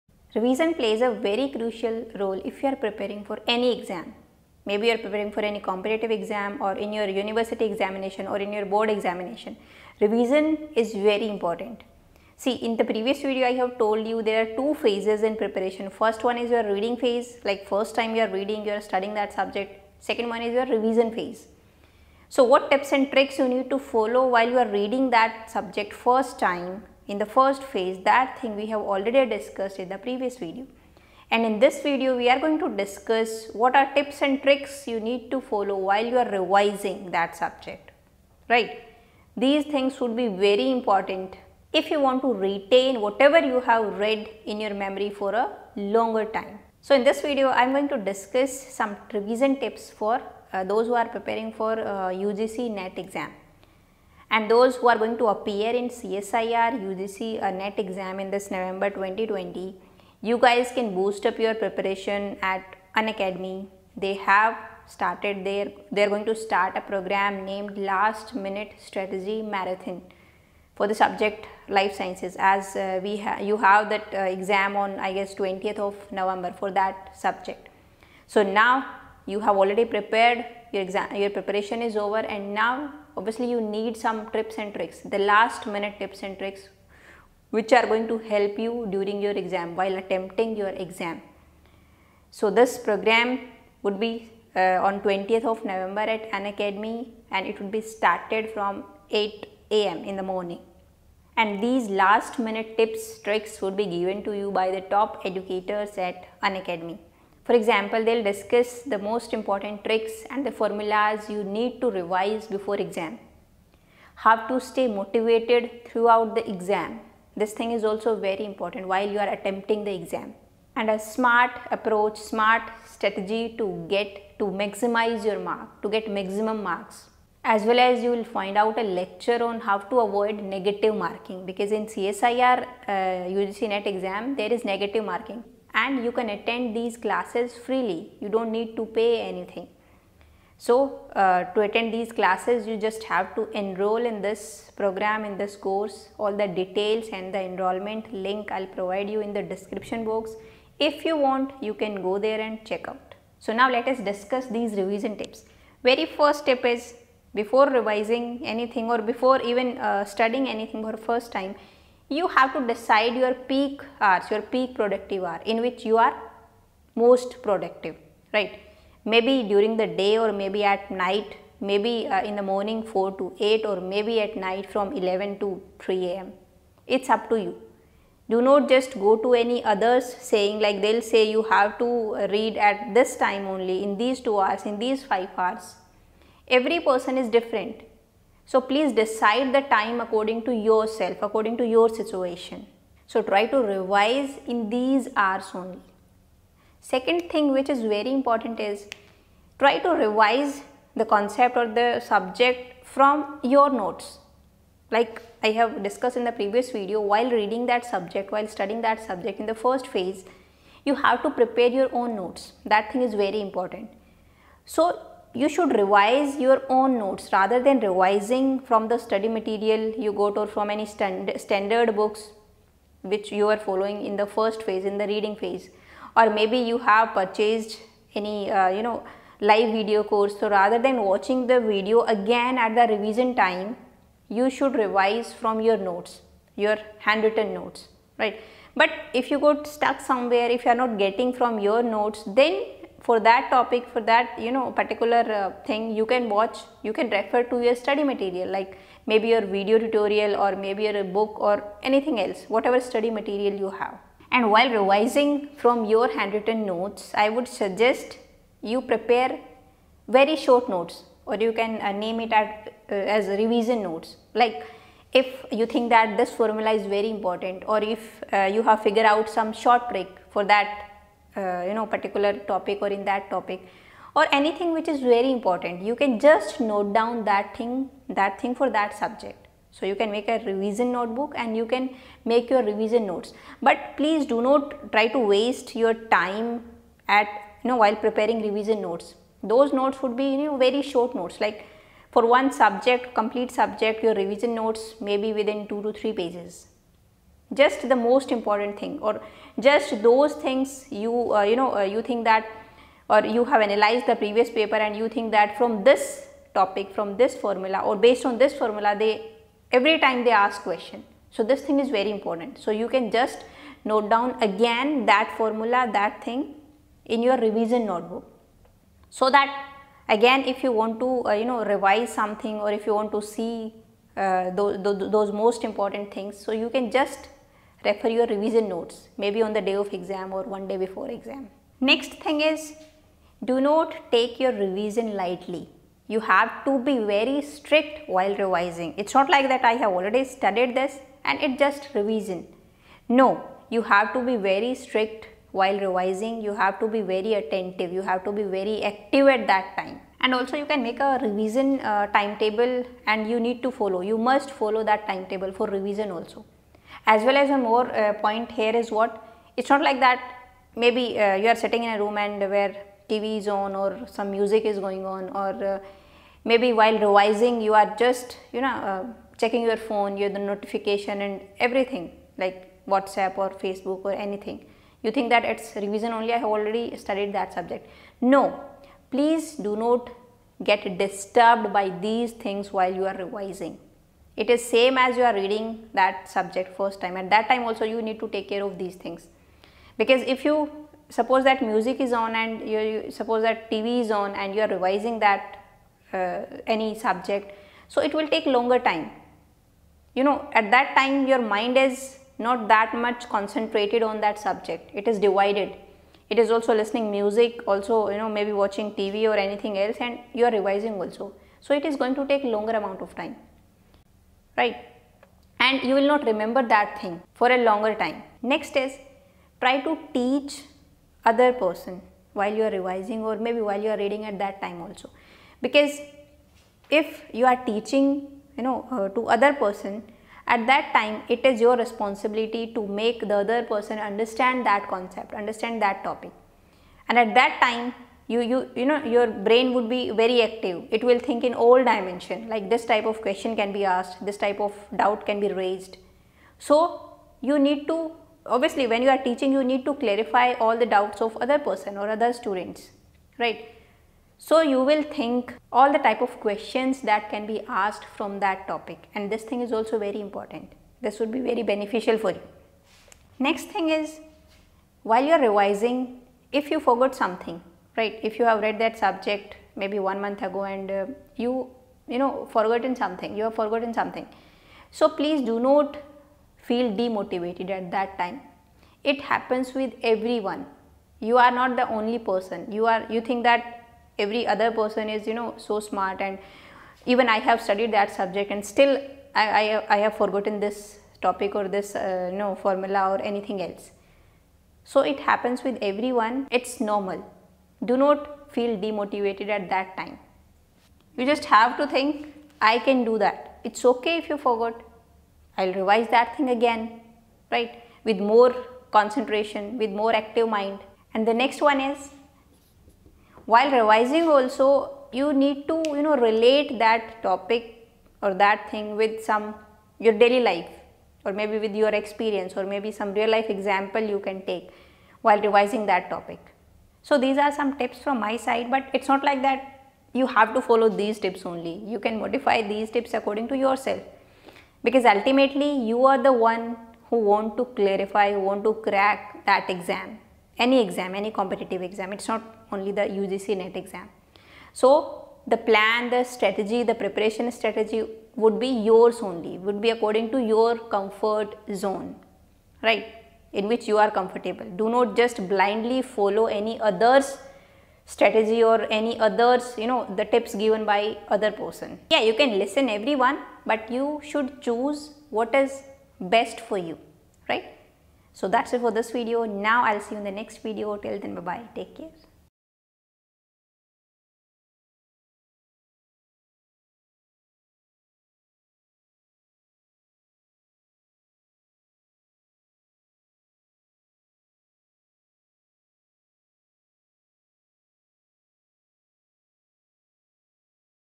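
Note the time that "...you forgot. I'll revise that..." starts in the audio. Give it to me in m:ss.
8:24.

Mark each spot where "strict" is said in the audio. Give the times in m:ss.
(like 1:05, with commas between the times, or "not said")
5:37, 5:44.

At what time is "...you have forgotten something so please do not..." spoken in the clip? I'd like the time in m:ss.
7:53.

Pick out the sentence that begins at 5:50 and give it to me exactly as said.
And also you can make a revision uh, timetable and you need to follow.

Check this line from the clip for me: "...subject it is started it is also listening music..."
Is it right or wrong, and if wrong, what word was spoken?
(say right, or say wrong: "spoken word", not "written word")
wrong: "divided", not "started".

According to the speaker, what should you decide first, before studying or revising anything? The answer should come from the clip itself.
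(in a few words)
Peak productive hour.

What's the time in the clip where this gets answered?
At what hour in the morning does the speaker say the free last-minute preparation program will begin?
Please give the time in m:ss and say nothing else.
1:39.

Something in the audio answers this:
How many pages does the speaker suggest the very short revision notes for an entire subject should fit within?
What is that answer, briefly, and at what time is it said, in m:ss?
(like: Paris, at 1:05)
2 to 3 pages, at 4:55.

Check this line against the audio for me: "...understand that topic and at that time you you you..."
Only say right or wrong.
right.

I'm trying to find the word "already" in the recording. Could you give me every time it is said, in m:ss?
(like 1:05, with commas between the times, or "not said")
0:28, 1:19, 5:39, 6:16.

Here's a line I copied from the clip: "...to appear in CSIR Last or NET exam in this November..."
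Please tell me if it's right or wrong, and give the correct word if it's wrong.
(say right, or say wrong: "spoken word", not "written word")
wrong: "UGC", not "Last".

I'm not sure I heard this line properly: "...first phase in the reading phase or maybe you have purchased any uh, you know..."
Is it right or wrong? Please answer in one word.
right.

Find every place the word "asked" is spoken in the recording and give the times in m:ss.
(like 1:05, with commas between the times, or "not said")
7:23, 7:37.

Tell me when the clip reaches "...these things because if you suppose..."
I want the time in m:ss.
6:28.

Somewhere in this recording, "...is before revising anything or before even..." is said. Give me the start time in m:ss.
2:36.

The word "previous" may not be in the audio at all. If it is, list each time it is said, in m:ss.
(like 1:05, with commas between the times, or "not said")
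0:12, 0:29, 3:26, 5:04.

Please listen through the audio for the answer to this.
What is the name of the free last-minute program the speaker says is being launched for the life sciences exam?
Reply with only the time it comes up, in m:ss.
1:07.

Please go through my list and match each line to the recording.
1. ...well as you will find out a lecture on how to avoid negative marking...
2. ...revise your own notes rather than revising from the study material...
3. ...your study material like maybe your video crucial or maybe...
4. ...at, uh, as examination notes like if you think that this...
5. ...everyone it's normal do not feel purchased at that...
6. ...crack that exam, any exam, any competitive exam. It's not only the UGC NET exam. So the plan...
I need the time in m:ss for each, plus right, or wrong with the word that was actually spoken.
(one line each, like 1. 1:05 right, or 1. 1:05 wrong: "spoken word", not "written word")
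1. 2:07 right
2. 3:35 right
3. 4:07 wrong: "tutorial", not "crucial"
4. 4:22 wrong: "revision", not "examination"
5. 8:15 wrong: "demotivated", not "purchased"
6. 8:58 right.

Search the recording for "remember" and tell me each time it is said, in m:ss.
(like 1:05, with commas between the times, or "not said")
6:56.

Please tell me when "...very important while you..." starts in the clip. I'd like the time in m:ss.
1:58.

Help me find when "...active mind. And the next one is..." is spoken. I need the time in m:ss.
8:30.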